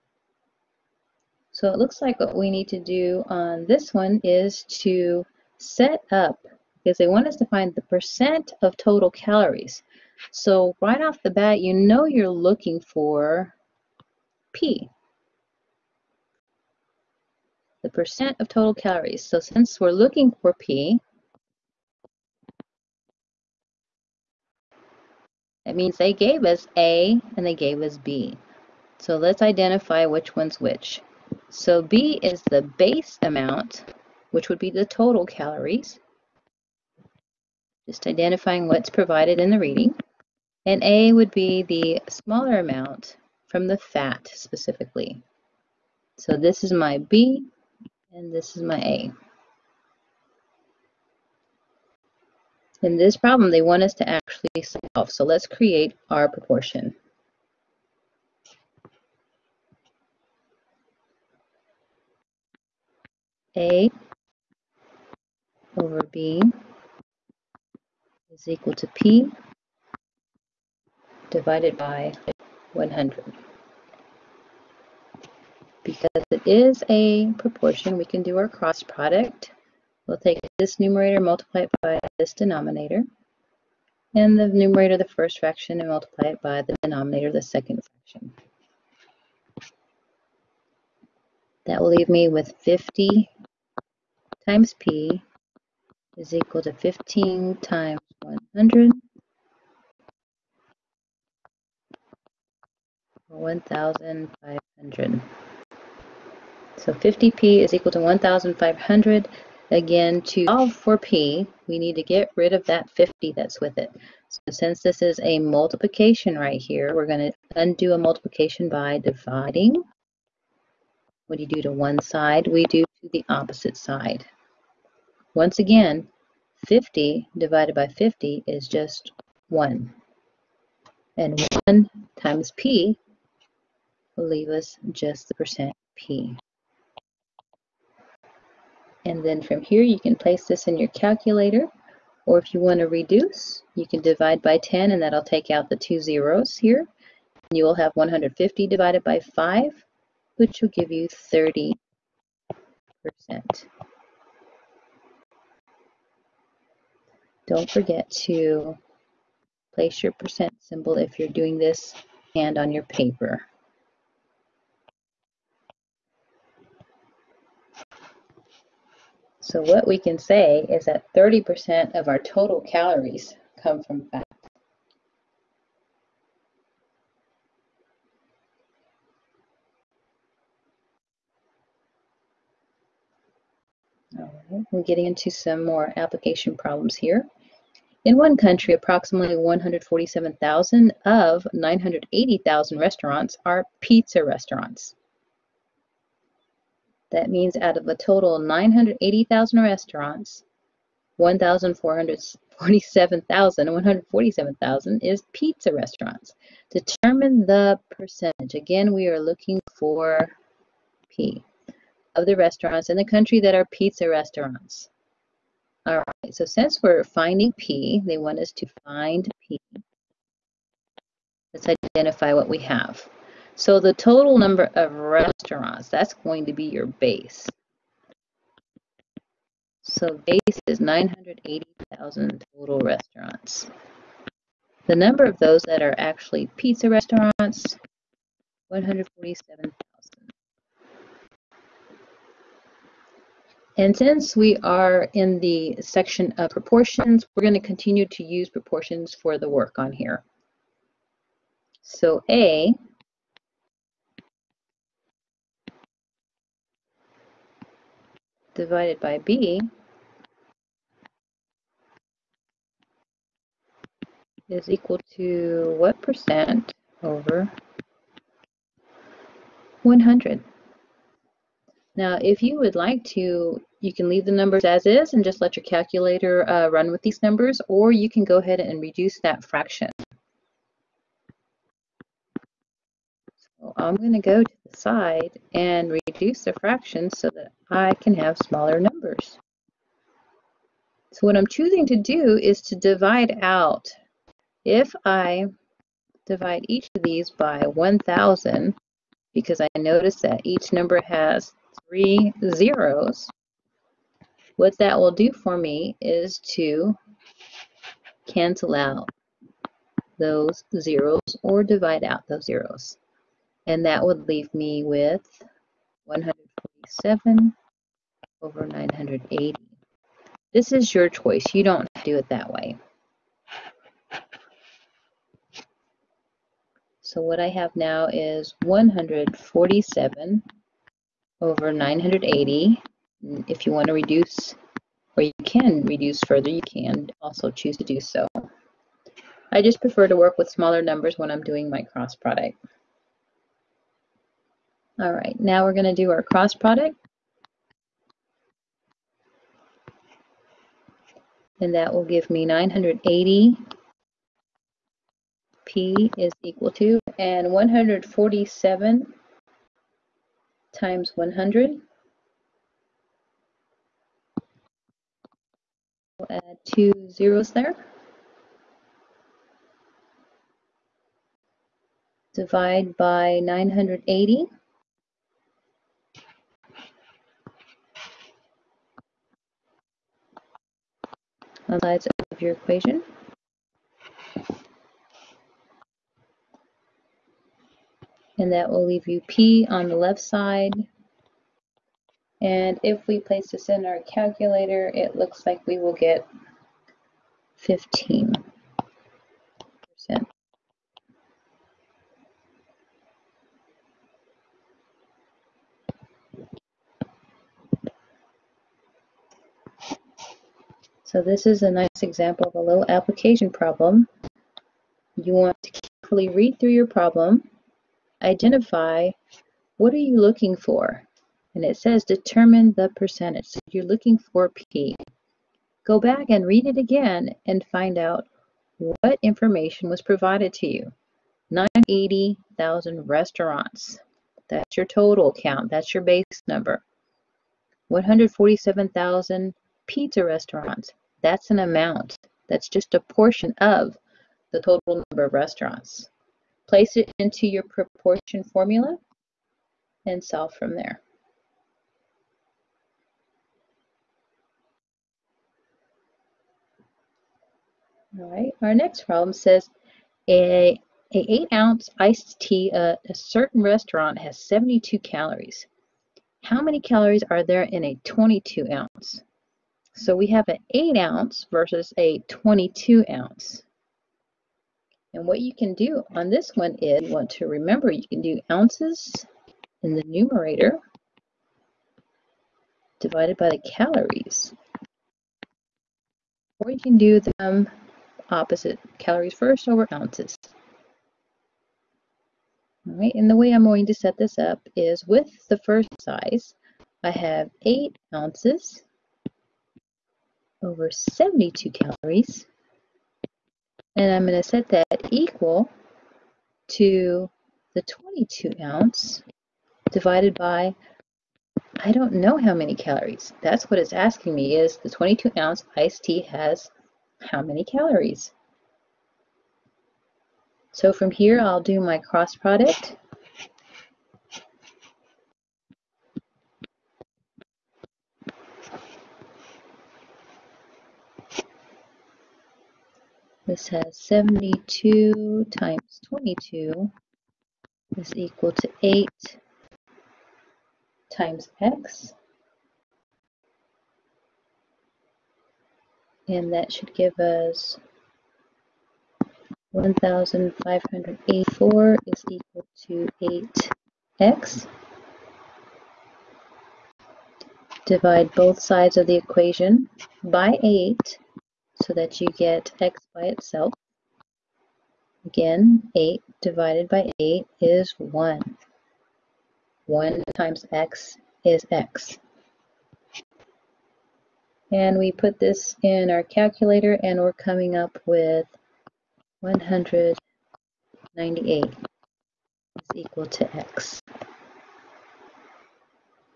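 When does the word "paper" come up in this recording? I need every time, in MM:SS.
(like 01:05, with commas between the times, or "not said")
02:42.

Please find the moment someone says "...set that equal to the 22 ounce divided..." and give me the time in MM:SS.
08:24.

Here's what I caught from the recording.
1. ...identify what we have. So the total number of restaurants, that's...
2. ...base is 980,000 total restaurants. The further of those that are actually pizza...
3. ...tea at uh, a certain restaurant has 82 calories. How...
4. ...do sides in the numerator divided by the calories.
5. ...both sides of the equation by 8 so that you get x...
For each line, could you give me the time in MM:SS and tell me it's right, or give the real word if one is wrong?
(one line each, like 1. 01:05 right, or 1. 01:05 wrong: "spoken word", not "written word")
1. 03:41 right
2. 03:50 wrong: "number", not "further"
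3. 07:42 wrong: "72", not "82"
4. 07:58 wrong: "ounces", not "sides"
5. 09:18 right.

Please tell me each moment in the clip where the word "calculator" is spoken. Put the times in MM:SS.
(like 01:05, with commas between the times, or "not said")
02:20, 04:35, 06:34, 09:36.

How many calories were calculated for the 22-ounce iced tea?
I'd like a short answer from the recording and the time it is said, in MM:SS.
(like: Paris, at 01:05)
198, at 09:39.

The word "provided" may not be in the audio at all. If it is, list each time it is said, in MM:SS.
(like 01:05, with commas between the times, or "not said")
00:38, 07:10.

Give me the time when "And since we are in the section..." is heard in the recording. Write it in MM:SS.
04:03.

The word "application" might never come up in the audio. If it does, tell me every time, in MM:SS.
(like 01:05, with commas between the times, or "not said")
03:05, 06:52.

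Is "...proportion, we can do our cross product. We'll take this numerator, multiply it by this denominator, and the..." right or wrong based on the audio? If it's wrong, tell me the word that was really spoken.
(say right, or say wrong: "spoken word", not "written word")
right.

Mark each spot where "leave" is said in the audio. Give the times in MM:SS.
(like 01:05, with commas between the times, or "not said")
01:31, 02:14, 04:34, 05:14, 06:28.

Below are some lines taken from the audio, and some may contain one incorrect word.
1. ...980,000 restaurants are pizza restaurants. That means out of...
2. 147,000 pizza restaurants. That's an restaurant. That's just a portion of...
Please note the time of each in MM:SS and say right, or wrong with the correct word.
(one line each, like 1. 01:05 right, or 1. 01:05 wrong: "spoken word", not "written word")
1. 03:11 right
2. 07:17 wrong: "amount", not "restaurant".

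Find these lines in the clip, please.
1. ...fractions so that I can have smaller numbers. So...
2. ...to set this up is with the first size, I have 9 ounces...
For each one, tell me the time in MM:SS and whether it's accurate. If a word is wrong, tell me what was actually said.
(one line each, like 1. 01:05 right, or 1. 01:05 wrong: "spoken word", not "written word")
1. 04:46 right
2. 08:13 wrong: "8", not "9".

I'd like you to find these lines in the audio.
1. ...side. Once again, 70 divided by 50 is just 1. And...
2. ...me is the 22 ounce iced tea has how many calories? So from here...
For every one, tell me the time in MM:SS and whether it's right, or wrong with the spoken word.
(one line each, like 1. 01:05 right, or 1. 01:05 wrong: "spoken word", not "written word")
1. 02:03 wrong: "50", not "70"
2. 08:34 right.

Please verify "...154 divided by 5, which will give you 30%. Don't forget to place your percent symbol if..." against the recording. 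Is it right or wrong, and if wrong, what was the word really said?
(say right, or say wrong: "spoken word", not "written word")
wrong: "150", not "154".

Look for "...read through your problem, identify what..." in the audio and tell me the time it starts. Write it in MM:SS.
06:56.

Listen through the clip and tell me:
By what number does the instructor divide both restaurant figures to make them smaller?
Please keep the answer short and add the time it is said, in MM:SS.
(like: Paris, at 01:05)
1,000, at 04:57.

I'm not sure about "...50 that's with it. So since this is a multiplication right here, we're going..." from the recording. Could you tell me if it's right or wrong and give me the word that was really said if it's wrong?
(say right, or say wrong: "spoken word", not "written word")
right.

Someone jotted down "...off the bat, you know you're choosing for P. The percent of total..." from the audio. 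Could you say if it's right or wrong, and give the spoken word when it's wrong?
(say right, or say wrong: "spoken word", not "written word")
wrong: "looking", not "choosing".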